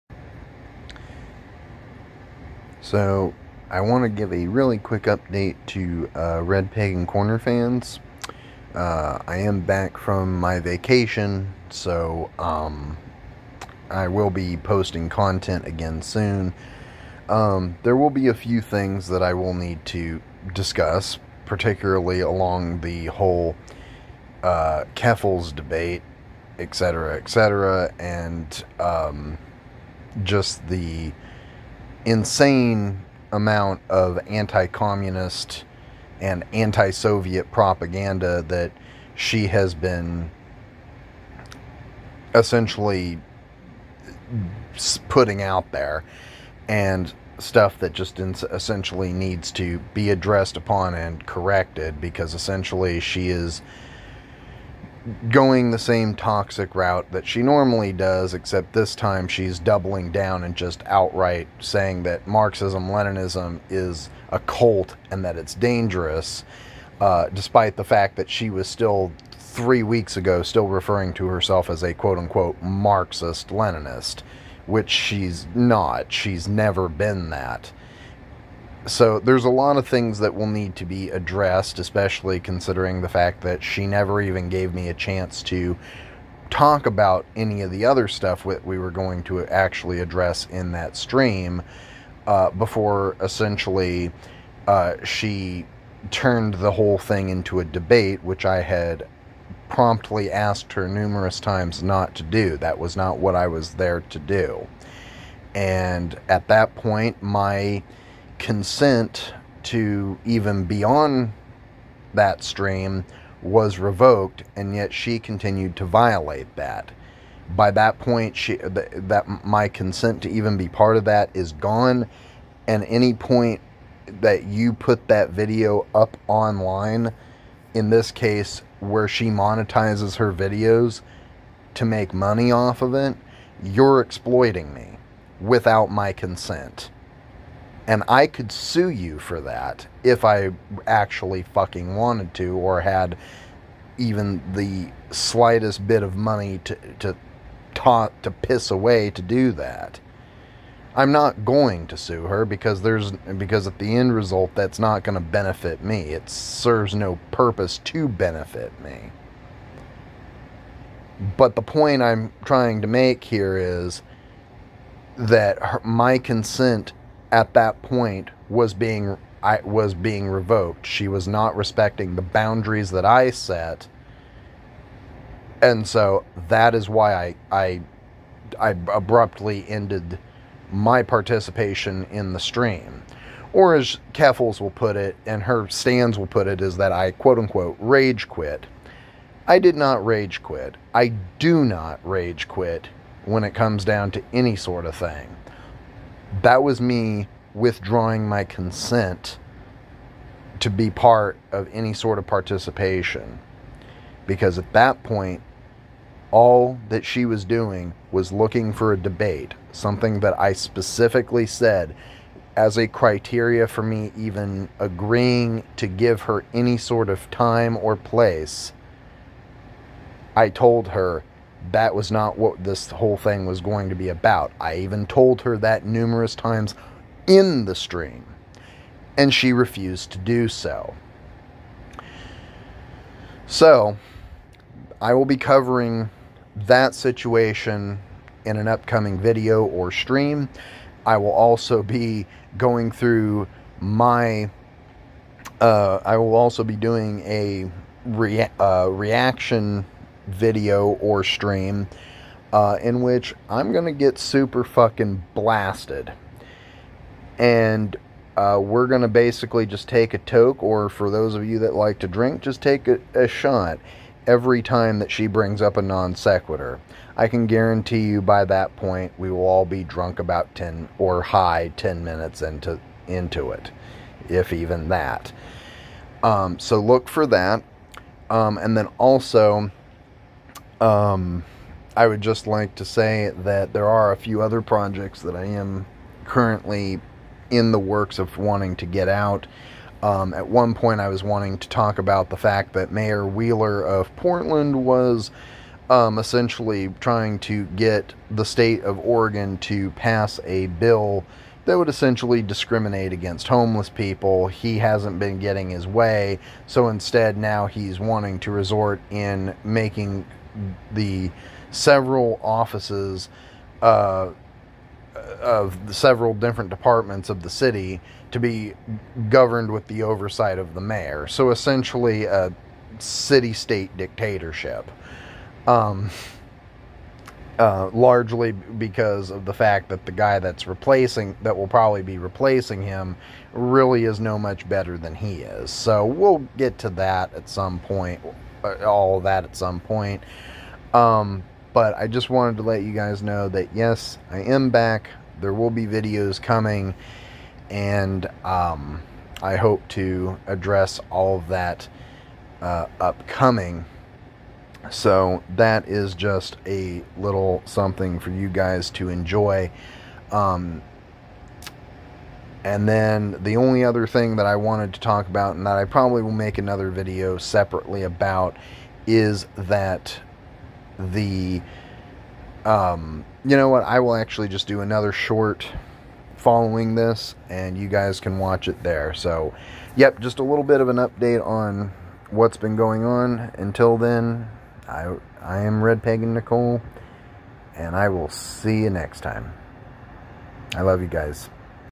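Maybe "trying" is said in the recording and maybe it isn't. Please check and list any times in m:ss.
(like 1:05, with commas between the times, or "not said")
2:42, 4:56.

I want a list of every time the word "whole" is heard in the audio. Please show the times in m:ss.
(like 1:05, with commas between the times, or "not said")
0:23, 1:36, 3:42.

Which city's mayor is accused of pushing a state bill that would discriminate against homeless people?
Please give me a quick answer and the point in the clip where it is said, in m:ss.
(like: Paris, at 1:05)
Portland, at 4:54.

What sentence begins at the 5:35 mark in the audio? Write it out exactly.
So we'll get to that at some point.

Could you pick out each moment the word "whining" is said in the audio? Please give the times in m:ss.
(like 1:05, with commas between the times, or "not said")
not said.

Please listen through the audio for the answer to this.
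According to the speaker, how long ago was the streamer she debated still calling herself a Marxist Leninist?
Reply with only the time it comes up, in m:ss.
1:09.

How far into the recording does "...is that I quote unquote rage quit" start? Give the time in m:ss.
3:06.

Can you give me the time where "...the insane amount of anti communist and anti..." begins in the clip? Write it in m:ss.
0:30.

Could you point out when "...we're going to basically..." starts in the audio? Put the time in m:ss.
4:18.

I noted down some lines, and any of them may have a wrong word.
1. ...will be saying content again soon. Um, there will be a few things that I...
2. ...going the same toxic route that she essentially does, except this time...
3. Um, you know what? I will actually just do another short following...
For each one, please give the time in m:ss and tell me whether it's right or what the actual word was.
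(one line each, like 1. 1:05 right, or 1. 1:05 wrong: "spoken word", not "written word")
1. 0:14 wrong: "posting", not "saying"
2. 0:55 wrong: "normally", not "essentially"
3. 6:12 right.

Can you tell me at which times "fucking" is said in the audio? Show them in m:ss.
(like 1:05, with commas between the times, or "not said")
2:21, 4:14.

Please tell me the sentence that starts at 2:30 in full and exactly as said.
I'm not going to sue her because there's because at the end result that's not going to benefit me.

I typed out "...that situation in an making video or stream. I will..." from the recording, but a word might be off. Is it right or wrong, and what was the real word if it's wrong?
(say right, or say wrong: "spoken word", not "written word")
wrong: "upcoming", not "making".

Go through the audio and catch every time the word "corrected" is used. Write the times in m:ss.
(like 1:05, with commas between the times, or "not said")
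0:51.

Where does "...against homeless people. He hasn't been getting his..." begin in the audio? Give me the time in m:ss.
5:03.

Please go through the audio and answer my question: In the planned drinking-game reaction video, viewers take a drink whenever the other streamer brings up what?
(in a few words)
a non sequitur.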